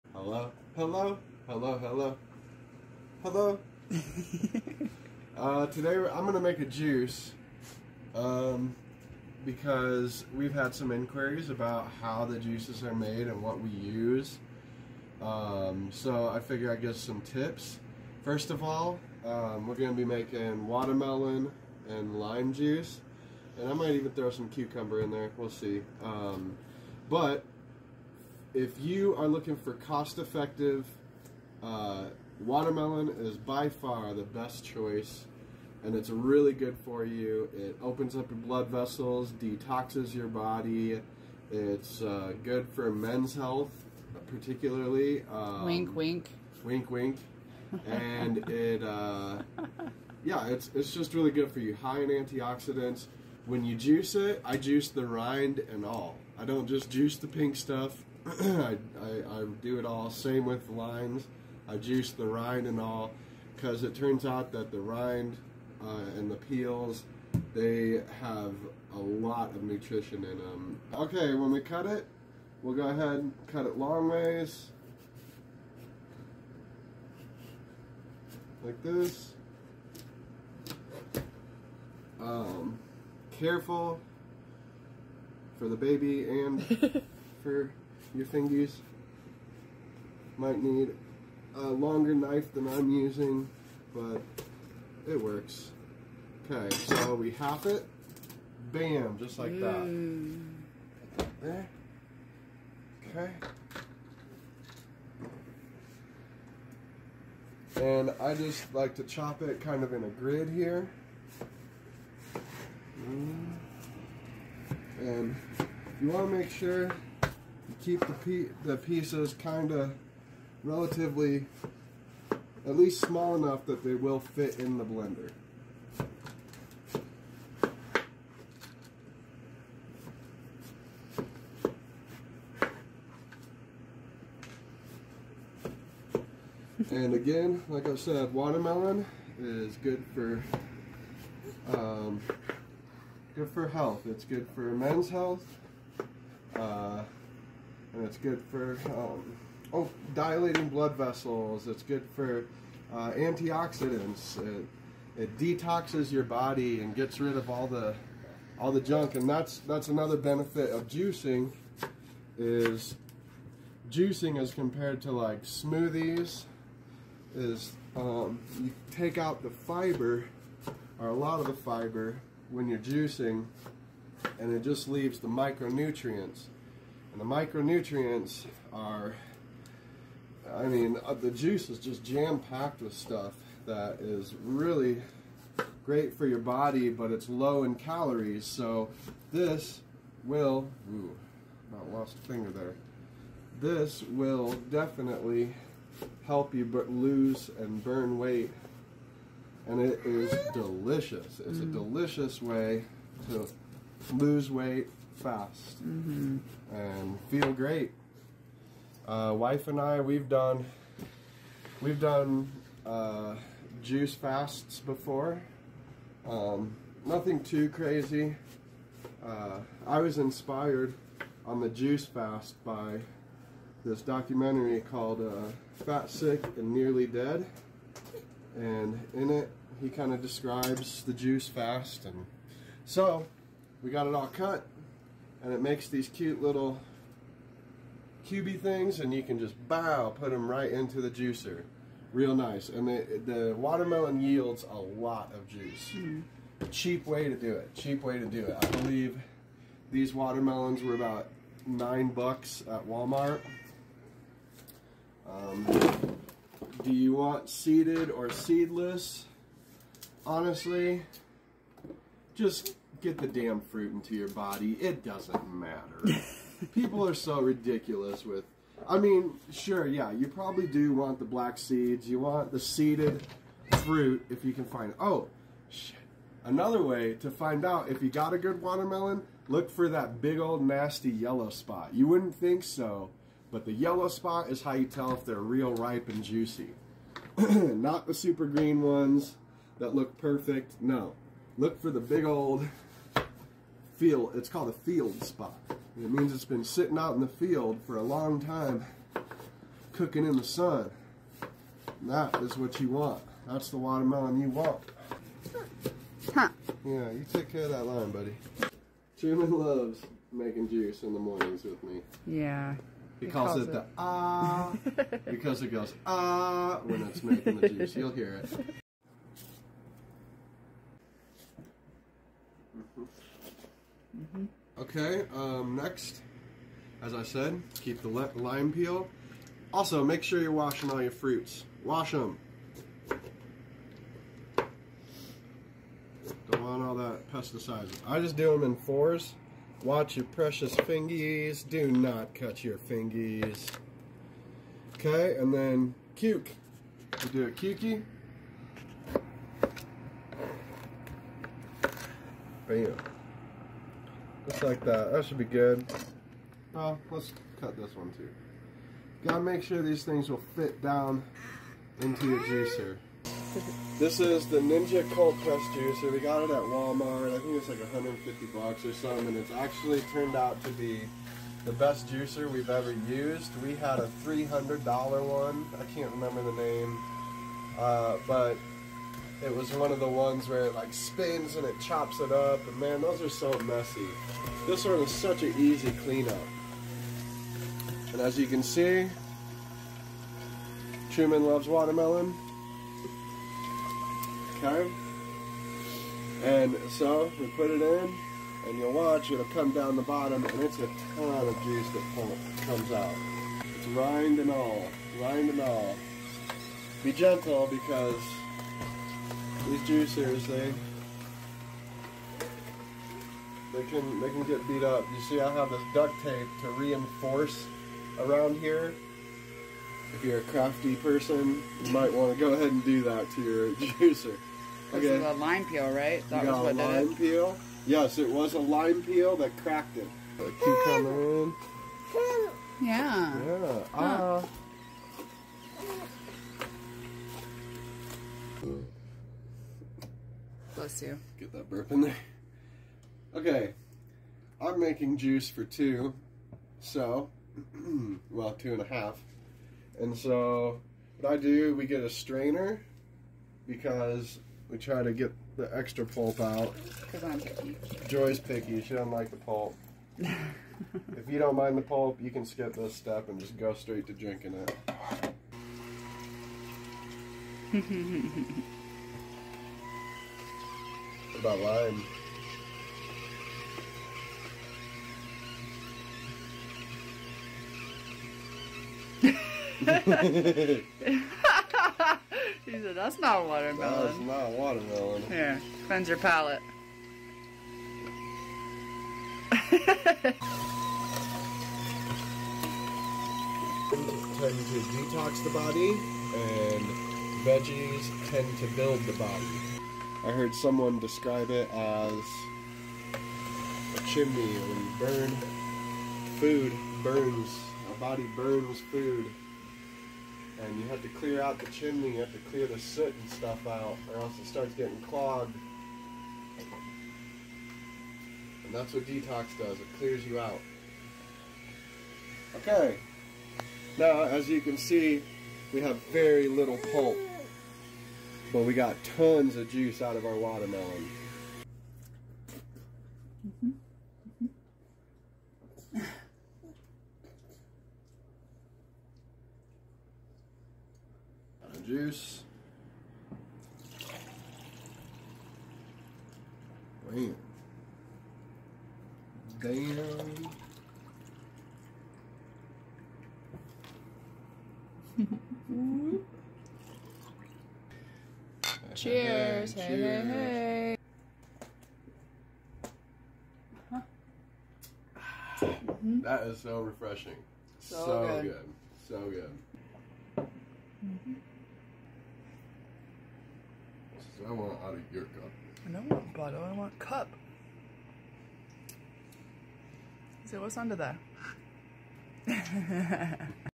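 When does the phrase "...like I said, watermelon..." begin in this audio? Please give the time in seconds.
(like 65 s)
137 s.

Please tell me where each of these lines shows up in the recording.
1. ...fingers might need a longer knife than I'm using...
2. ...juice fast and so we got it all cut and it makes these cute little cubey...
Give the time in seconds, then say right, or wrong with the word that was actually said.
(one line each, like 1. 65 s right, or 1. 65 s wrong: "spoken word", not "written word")
1. 88 s right
2. 231 s right.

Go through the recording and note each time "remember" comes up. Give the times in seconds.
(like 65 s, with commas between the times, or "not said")
376 s.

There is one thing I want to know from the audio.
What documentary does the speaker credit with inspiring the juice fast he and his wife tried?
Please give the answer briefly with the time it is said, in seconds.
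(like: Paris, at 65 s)
Fat, Sick, and Nearly Dead, at 225 s.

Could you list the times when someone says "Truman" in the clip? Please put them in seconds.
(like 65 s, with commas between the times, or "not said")
309 s, 391 s.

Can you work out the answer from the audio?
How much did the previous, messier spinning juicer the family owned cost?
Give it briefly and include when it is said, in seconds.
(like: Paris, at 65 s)
$300, at 374 s.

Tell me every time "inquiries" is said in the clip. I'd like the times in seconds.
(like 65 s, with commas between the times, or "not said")
10 s.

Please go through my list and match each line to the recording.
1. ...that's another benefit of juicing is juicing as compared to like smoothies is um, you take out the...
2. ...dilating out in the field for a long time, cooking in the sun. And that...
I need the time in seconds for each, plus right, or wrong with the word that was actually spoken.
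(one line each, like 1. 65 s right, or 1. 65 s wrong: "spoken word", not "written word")
1. 159 s right
2. 296 s wrong: "sitting", not "dilating".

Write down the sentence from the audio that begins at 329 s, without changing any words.
Also, make sure you're washing all your fruits.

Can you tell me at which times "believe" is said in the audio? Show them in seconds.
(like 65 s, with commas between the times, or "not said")
248 s.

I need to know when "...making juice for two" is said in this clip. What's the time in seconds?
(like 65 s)
444 s.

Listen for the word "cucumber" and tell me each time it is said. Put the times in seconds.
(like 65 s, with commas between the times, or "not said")
24 s, 430 s.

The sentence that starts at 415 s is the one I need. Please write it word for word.
You see, I have this duct tape to reinforce around here.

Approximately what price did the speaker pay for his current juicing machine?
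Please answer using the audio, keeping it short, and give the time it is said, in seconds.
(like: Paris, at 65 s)
150 dollars, at 367 s.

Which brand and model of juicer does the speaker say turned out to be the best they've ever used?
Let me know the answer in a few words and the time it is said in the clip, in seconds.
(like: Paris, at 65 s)
Ninja Cold Press Juicer, at 364 s.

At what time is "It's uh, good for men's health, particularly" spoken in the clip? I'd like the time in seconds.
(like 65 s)
41 s.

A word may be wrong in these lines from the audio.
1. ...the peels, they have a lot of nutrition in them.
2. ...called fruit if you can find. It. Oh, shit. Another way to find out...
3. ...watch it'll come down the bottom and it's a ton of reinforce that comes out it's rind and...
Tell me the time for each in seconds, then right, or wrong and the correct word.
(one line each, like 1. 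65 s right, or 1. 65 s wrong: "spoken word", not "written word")
1. 66 s right
2. 272 s wrong: "seeded", not "called"
3. 398 s wrong: "juice", not "reinforce".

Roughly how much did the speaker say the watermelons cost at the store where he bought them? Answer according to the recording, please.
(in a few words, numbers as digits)
9 dollars.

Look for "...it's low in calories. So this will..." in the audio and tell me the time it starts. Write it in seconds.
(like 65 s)
187 s.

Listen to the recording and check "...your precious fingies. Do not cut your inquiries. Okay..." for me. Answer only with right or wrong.
wrong.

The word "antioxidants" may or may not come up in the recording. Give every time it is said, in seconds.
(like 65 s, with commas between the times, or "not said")
52 s, 153 s.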